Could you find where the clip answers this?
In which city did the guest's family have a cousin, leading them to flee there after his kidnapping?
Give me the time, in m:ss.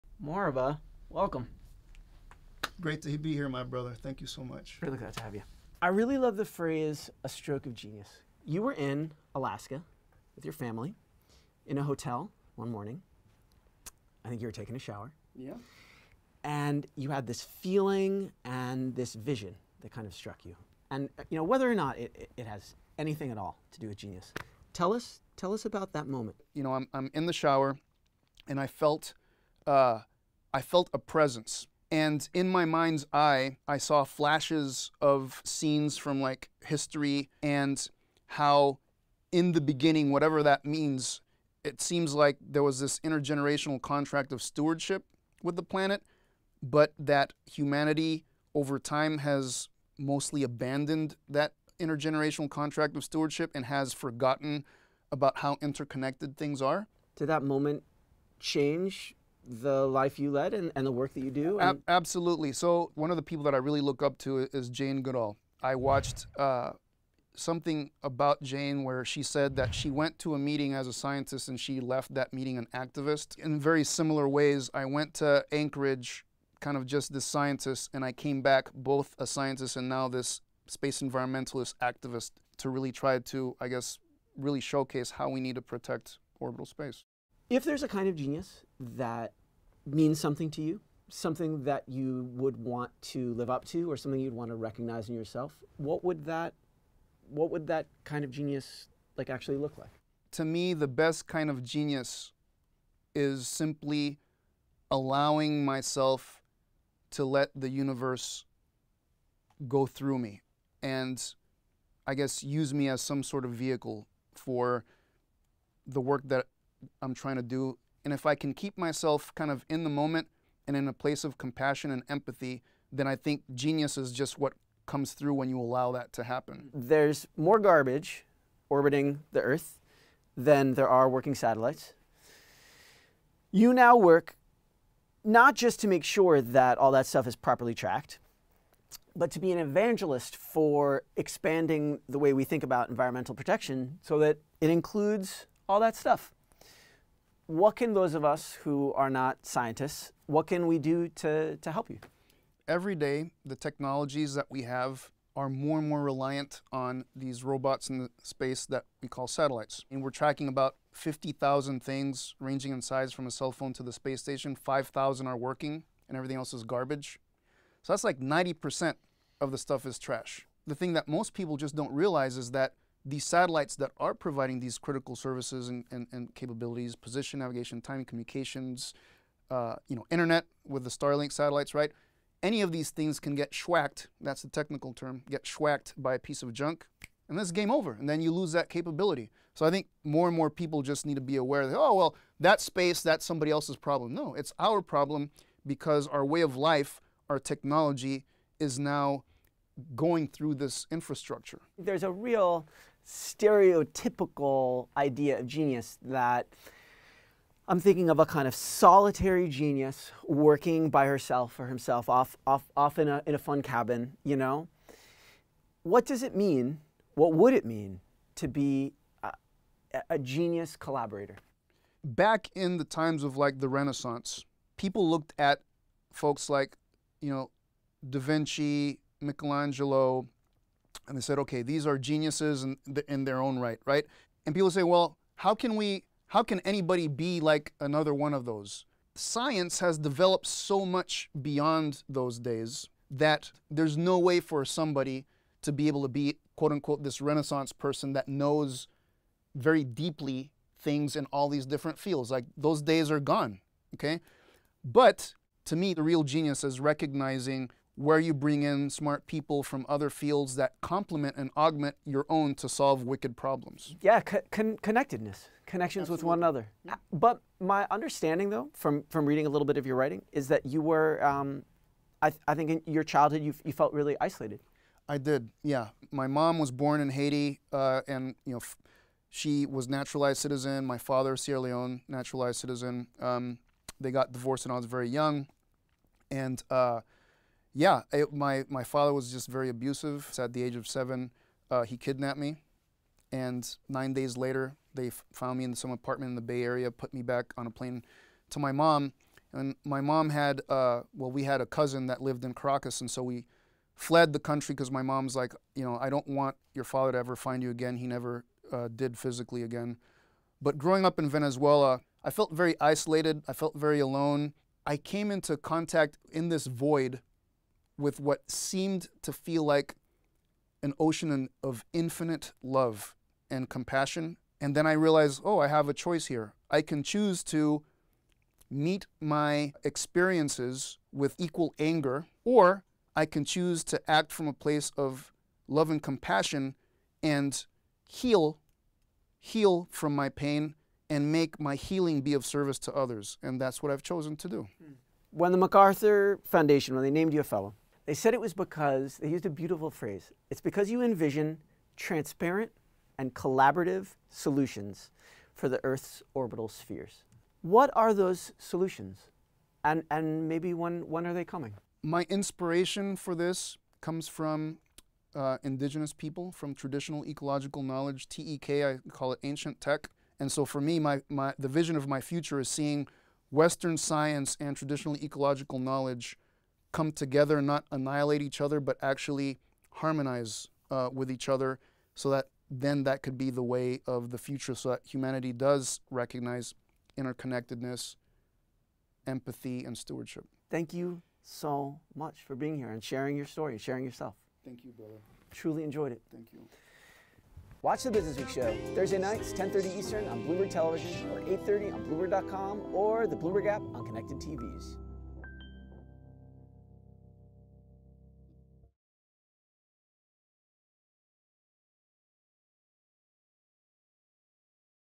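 5:02.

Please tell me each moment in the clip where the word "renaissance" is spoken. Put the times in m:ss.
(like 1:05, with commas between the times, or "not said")
3:43, 4:07.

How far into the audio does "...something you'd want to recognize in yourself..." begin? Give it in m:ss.
1:33.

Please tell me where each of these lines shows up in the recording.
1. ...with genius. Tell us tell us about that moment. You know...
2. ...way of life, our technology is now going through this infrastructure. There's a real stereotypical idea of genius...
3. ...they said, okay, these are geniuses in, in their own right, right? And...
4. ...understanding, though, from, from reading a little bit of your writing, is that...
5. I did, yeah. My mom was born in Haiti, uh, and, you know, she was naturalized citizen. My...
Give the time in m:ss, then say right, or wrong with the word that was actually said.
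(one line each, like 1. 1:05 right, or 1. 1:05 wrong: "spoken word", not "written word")
1. 0:23 right
2. 3:16 right
3. 3:51 right
4. 4:27 right
5. 4:35 right.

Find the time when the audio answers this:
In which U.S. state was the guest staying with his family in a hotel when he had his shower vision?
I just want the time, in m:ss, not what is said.
0:09.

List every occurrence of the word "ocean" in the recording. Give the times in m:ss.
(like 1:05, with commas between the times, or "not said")
5:20.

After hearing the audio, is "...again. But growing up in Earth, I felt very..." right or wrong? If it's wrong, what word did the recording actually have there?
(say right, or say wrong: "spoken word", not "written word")
wrong: "Venezuela", not "Earth".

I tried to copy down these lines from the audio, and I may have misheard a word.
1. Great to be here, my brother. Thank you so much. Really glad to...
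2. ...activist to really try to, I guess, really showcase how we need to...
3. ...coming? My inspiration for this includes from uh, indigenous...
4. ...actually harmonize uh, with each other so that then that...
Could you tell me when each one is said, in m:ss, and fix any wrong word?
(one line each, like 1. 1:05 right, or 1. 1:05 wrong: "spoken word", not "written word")
1. 0:02 right
2. 1:21 right
3. 6:01 wrong: "comes", not "includes"
4. 6:19 right.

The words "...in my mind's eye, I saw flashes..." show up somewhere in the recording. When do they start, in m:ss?
0:32.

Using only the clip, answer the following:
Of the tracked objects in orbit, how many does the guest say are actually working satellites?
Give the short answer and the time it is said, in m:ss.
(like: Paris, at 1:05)
5,000, at 2:44.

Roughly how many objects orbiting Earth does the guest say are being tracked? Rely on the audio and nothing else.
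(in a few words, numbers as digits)
50,000.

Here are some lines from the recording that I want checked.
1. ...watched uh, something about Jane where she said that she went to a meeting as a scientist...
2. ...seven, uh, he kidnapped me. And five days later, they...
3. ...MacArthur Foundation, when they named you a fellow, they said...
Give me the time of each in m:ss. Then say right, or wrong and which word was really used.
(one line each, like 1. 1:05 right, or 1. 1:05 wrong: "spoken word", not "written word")
1. 1:05 right
2. 4:50 wrong: "nine", not "five"
3. 5:45 right.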